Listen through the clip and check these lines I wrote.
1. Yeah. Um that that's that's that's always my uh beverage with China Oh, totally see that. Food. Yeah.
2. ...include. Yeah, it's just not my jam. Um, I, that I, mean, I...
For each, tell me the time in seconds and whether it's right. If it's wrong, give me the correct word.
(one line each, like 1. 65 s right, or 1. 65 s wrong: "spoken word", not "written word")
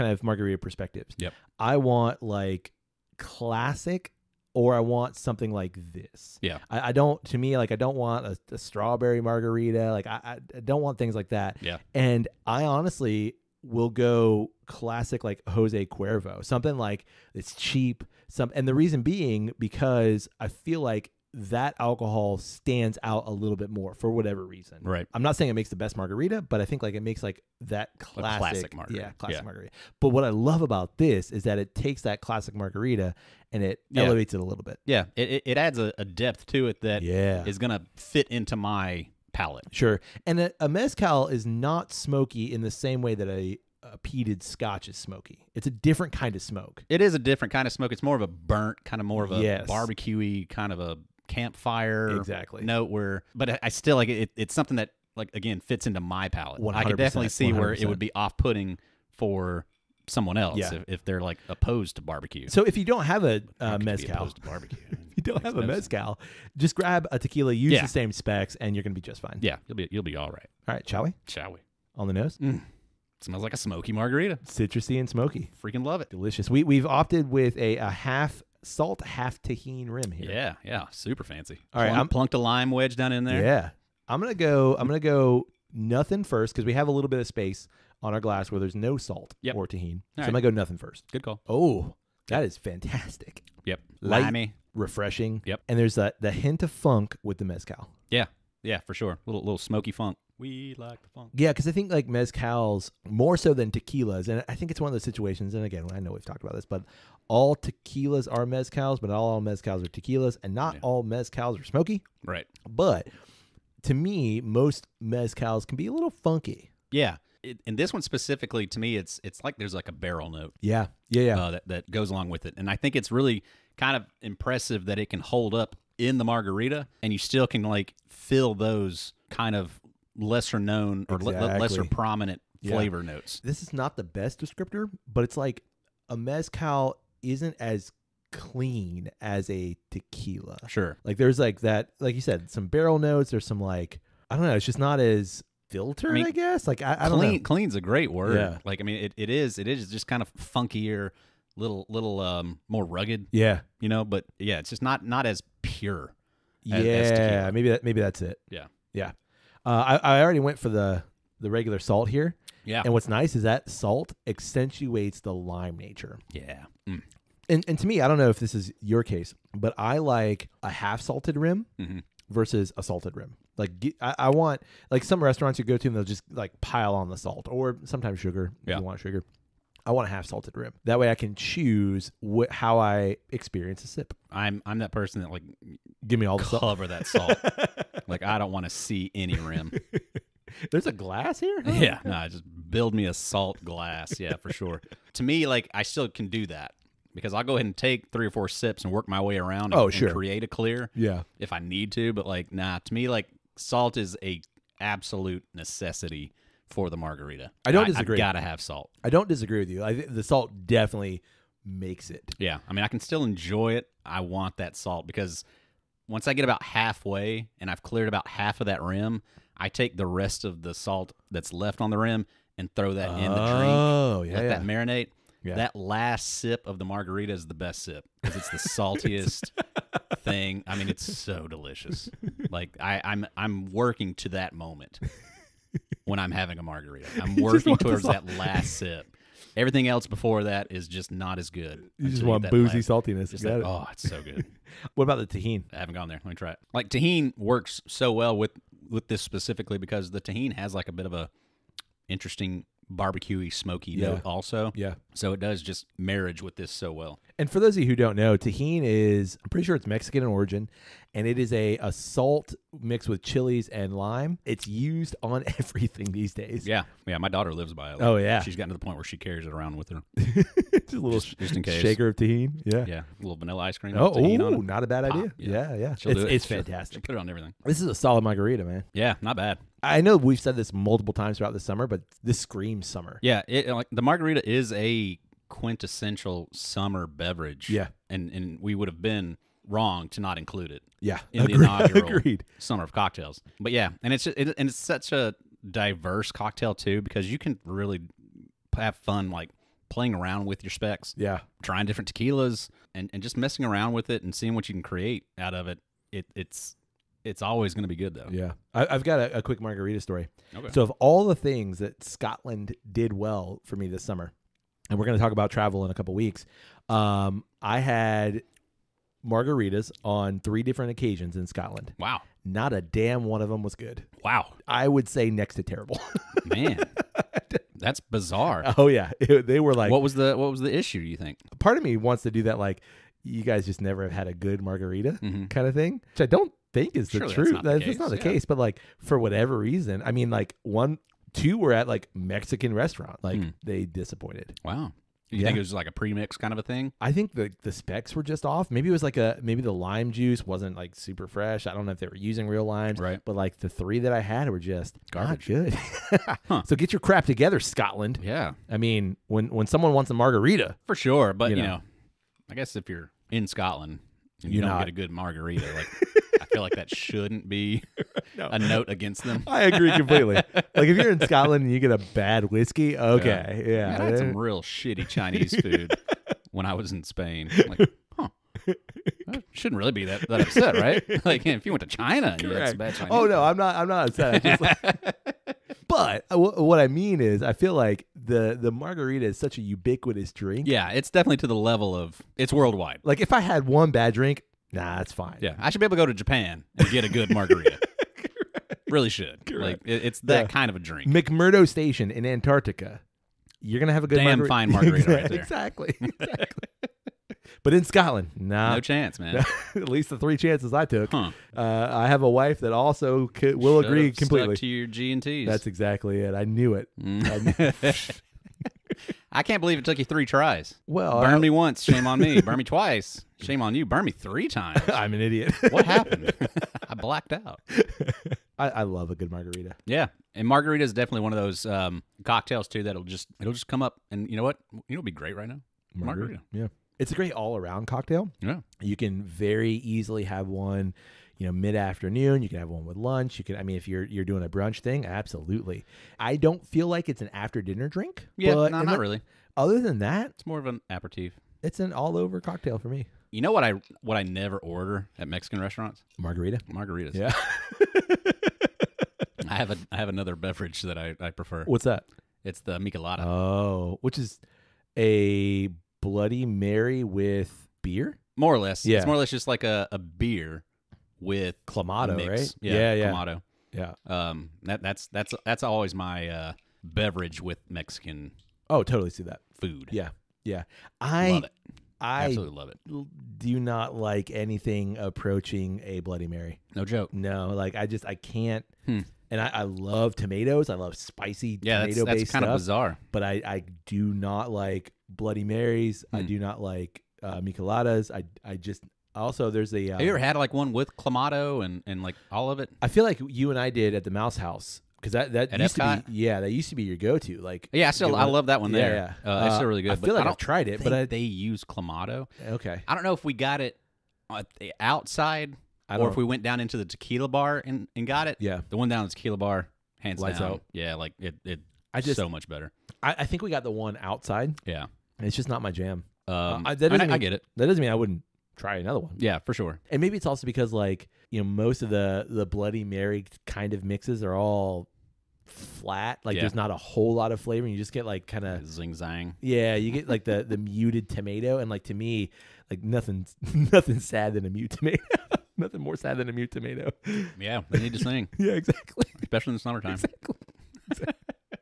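1. 473 s wrong: "Mexican", not "China"
2. 524 s wrong: "outside", not "include".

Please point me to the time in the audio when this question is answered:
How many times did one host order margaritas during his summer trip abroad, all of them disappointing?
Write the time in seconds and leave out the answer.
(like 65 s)
320 s.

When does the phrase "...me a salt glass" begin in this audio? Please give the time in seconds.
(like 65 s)
192 s.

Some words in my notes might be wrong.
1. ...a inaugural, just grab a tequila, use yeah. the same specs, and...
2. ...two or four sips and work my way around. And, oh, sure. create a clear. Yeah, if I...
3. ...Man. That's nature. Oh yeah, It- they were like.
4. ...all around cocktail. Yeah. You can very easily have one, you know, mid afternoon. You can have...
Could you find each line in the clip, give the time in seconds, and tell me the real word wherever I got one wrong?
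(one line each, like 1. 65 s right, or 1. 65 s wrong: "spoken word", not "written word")
1. 65 s wrong: "mezcal", not "inaugural"
2. 198 s wrong: "three", not "two"
3. 326 s wrong: "bizarre", not "nature"
4. 437 s right.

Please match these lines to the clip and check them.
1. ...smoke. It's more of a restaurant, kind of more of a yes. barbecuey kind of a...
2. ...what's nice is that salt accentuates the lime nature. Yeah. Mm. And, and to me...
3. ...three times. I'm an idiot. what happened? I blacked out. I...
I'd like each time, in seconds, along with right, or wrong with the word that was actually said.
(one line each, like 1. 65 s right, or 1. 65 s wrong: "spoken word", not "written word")
1. 47 s wrong: "burnt", not "restaurant"
2. 162 s right
3. 424 s right.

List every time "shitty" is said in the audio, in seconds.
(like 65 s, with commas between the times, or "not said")
374 s.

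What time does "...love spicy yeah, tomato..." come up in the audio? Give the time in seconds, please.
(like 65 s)
490 s.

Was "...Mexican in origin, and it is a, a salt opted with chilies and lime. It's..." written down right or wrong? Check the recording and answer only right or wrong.
wrong.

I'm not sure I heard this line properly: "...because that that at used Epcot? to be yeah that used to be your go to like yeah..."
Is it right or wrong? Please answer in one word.
right.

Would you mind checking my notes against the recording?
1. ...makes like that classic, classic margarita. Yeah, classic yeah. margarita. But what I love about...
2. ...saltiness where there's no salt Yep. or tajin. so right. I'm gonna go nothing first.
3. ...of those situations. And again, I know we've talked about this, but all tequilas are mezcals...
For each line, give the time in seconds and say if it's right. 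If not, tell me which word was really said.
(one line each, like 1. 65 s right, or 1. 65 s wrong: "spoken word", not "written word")
1. 27 s right
2. 88 s wrong: "glass", not "saltiness"
3. 104 s right.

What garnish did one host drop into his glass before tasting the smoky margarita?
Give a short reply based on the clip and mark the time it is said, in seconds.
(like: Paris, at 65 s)
A lime wedge, at 82 s.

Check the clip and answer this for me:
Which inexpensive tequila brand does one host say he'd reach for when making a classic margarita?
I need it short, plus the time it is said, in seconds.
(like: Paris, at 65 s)
Jose Cuervo, at 15 s.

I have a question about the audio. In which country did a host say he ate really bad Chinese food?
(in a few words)
Spain.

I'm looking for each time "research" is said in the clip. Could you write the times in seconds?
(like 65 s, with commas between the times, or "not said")
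not said.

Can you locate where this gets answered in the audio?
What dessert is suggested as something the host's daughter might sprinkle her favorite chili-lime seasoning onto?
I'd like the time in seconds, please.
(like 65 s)
273 s.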